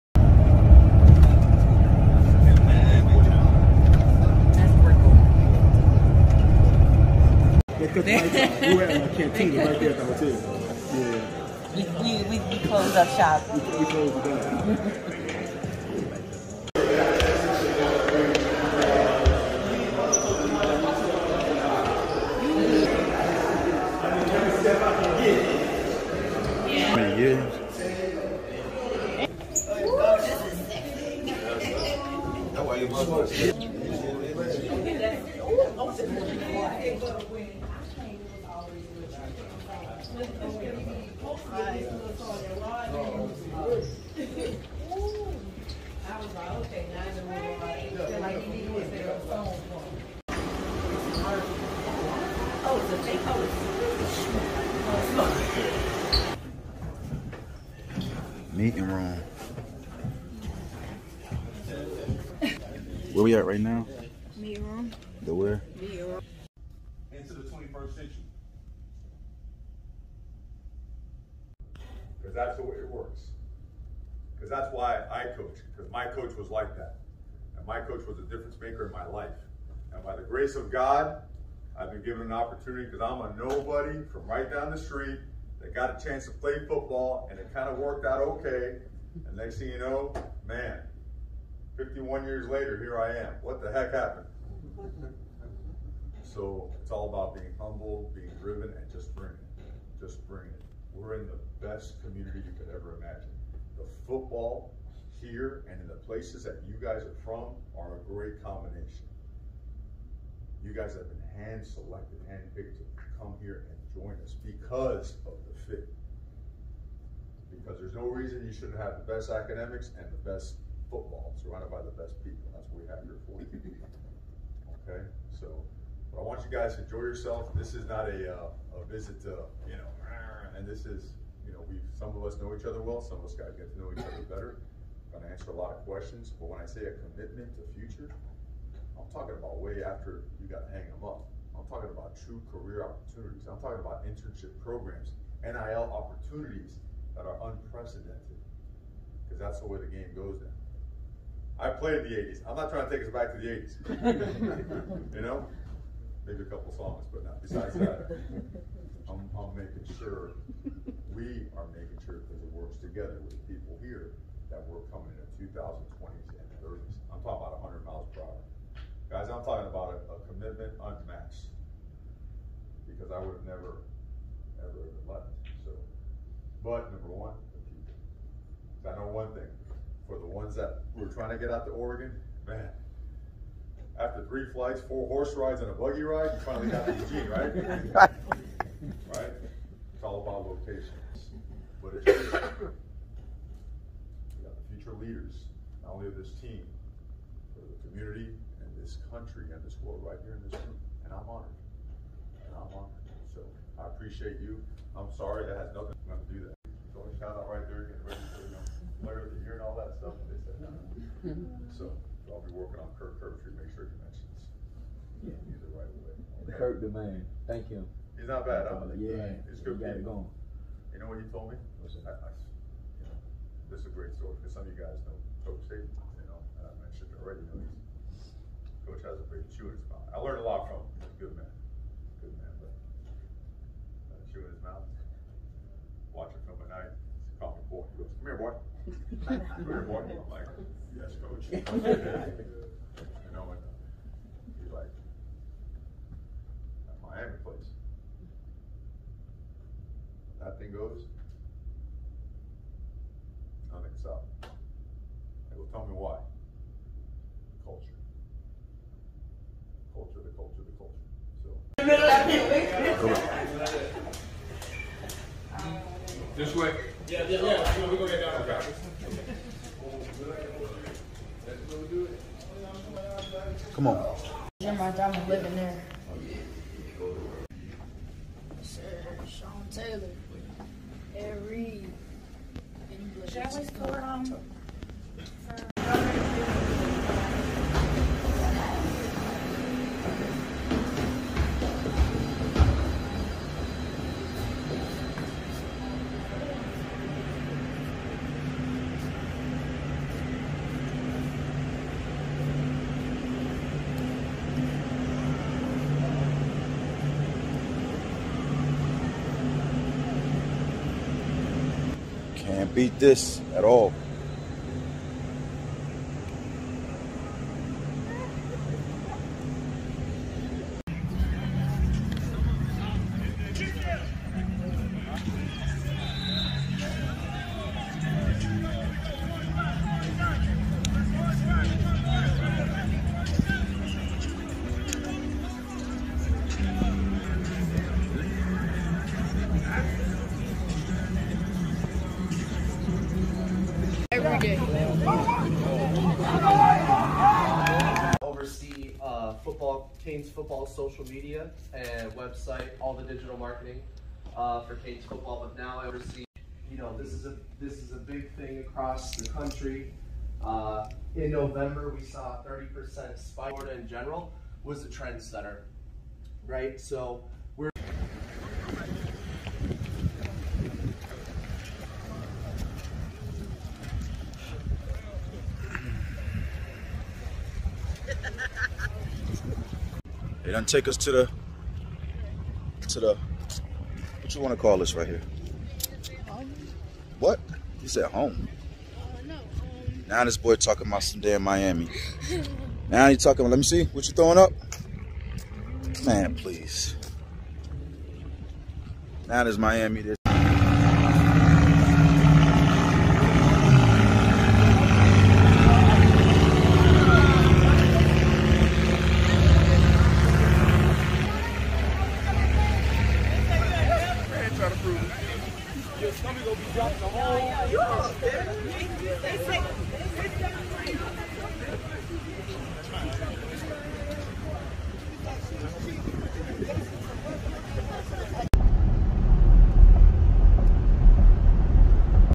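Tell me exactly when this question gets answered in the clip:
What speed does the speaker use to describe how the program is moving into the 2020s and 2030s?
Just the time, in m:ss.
2:47.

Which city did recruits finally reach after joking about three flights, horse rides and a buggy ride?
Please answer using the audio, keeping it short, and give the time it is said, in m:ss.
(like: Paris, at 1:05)
Eugene, at 3:06.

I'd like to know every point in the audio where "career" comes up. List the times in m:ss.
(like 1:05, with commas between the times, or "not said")
2:22.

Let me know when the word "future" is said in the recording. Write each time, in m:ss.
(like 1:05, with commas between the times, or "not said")
2:17, 3:14.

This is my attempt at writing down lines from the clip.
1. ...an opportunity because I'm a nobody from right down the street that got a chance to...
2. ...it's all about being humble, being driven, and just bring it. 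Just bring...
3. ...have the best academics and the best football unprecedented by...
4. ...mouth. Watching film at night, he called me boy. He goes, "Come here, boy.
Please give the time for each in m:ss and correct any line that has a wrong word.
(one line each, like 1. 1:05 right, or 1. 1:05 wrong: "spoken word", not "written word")
1. 1:22 right
2. 1:36 right
3. 1:58 wrong: "surrounded", not "unprecedented"
4. 3:54 right.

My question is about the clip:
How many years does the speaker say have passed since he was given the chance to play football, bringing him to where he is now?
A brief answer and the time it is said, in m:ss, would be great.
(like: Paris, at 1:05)
51, at 1:31.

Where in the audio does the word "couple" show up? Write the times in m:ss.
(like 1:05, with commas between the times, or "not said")
2:36.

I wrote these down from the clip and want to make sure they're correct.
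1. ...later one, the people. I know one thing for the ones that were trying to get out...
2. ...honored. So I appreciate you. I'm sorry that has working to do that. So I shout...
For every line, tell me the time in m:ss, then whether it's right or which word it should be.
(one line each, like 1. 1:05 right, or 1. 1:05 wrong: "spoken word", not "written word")
1. 2:56 wrong: "number", not "later"
2. 3:22 wrong: "nothing", not "working".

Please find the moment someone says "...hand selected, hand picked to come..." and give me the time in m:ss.
1:51.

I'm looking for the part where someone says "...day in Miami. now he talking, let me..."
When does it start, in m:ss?
6:31.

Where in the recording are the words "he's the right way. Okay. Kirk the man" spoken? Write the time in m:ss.
3:35.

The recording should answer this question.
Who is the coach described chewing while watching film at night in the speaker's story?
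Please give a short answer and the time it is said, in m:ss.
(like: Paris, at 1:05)
Coach Saban, at 3:45.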